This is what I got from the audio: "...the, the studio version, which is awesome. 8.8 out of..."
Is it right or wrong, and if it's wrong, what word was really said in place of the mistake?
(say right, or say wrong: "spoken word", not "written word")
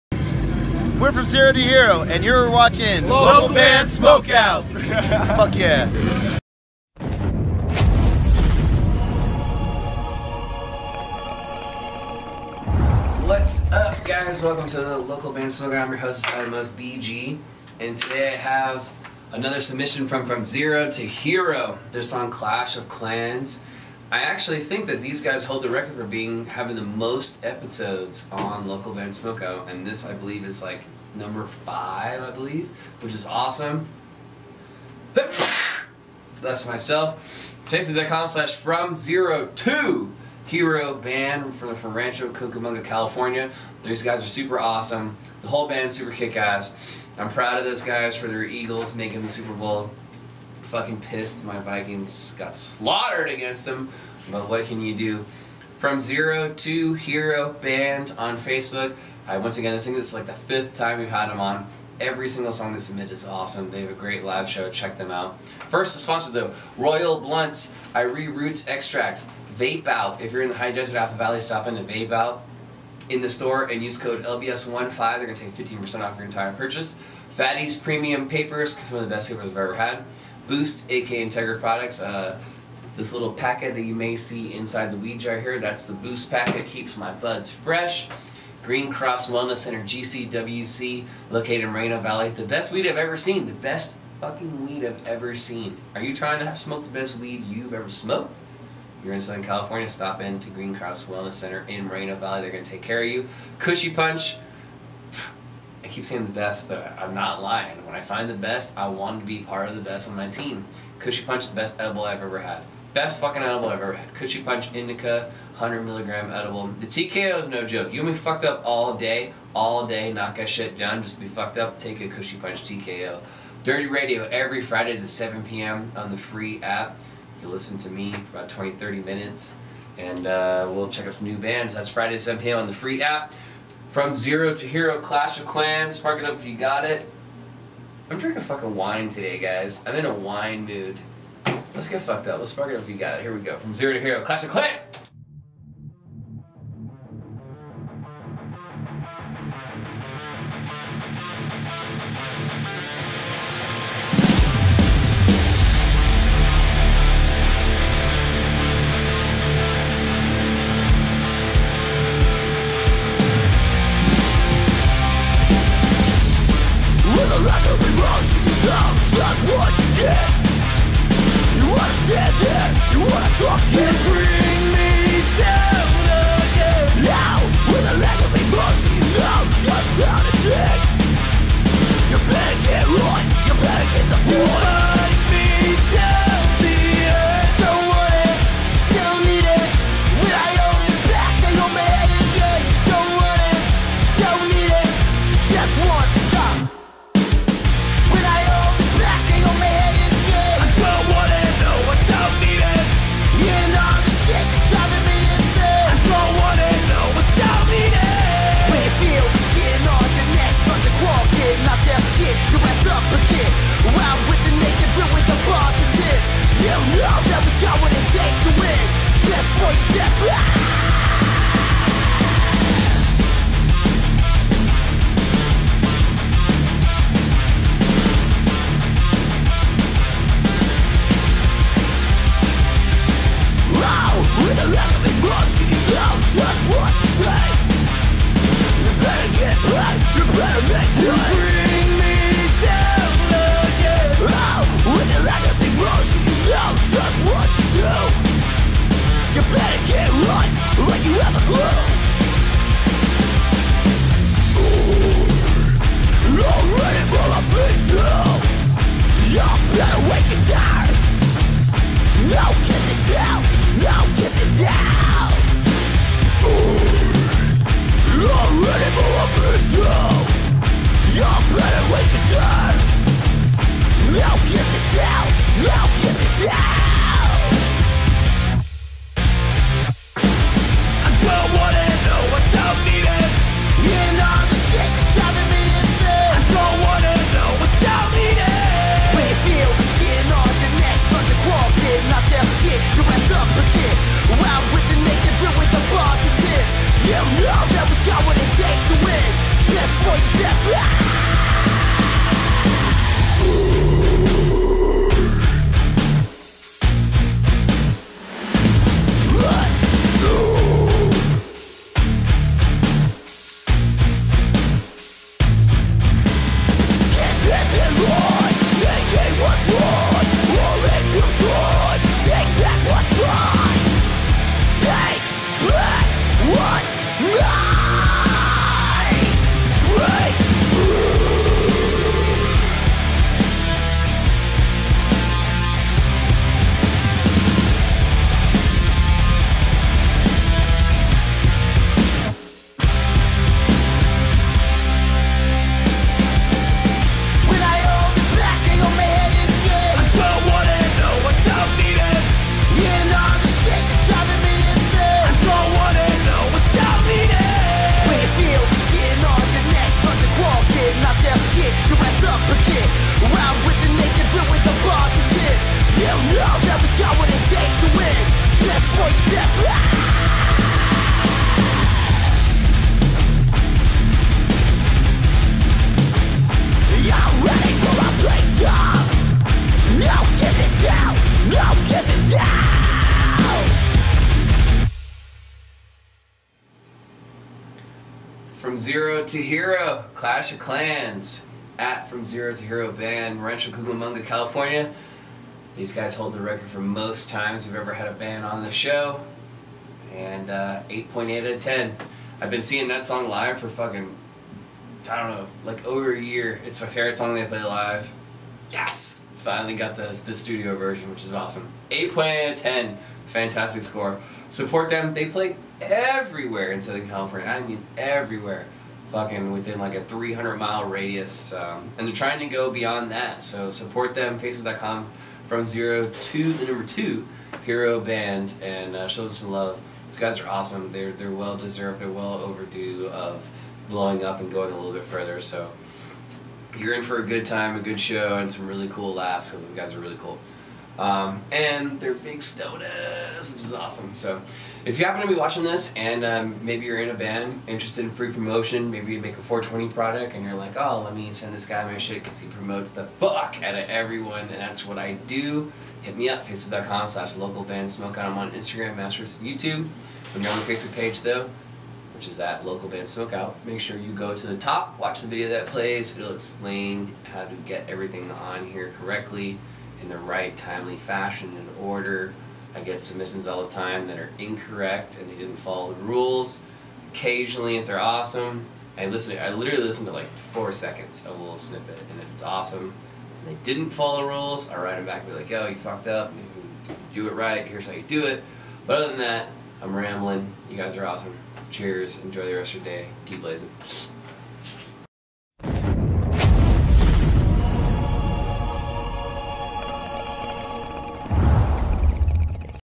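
right.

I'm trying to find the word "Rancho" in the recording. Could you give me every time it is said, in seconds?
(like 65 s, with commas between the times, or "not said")
41 s, 393 s.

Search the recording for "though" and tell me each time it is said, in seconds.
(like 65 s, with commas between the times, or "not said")
66 s, 461 s.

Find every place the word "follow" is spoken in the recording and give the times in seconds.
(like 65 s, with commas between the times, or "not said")
475 s, 483 s.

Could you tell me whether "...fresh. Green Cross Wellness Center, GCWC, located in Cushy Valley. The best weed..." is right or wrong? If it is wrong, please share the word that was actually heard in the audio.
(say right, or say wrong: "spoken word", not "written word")
wrong: "Reno", not "Cushy".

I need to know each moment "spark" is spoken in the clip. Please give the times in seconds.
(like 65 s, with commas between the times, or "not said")
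135 s, 142 s.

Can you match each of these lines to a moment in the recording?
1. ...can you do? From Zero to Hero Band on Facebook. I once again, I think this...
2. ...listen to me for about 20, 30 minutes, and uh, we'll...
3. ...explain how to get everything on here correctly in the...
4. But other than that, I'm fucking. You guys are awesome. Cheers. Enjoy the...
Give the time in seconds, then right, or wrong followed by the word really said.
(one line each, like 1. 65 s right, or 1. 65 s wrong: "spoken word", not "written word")
1. 54 s right
2. 127 s right
3. 466 s right
4. 488 s wrong: "rambling", not "fucking".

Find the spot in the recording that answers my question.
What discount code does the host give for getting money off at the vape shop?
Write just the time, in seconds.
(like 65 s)
74 s.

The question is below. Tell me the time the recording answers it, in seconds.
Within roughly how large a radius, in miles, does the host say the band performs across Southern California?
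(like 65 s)
420 s.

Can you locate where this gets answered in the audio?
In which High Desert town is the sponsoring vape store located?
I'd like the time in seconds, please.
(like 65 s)
70 s.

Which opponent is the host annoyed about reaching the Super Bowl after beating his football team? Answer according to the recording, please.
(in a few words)
Eagles.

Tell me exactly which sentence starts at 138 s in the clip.
I'm drinking fucking wine today, guys.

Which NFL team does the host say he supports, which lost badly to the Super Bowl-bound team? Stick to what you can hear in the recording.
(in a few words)
Vikings.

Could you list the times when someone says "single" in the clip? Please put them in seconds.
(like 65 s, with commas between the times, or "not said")
62 s.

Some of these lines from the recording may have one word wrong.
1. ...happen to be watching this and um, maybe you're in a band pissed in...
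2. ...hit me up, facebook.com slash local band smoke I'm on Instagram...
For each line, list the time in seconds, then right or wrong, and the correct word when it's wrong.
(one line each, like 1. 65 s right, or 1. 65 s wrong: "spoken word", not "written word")
1. 445 s wrong: "interested", not "pissed"
2. 456 s right.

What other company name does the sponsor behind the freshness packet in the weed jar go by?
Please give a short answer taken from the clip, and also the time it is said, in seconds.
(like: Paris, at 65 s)
Integra Products, at 81 s.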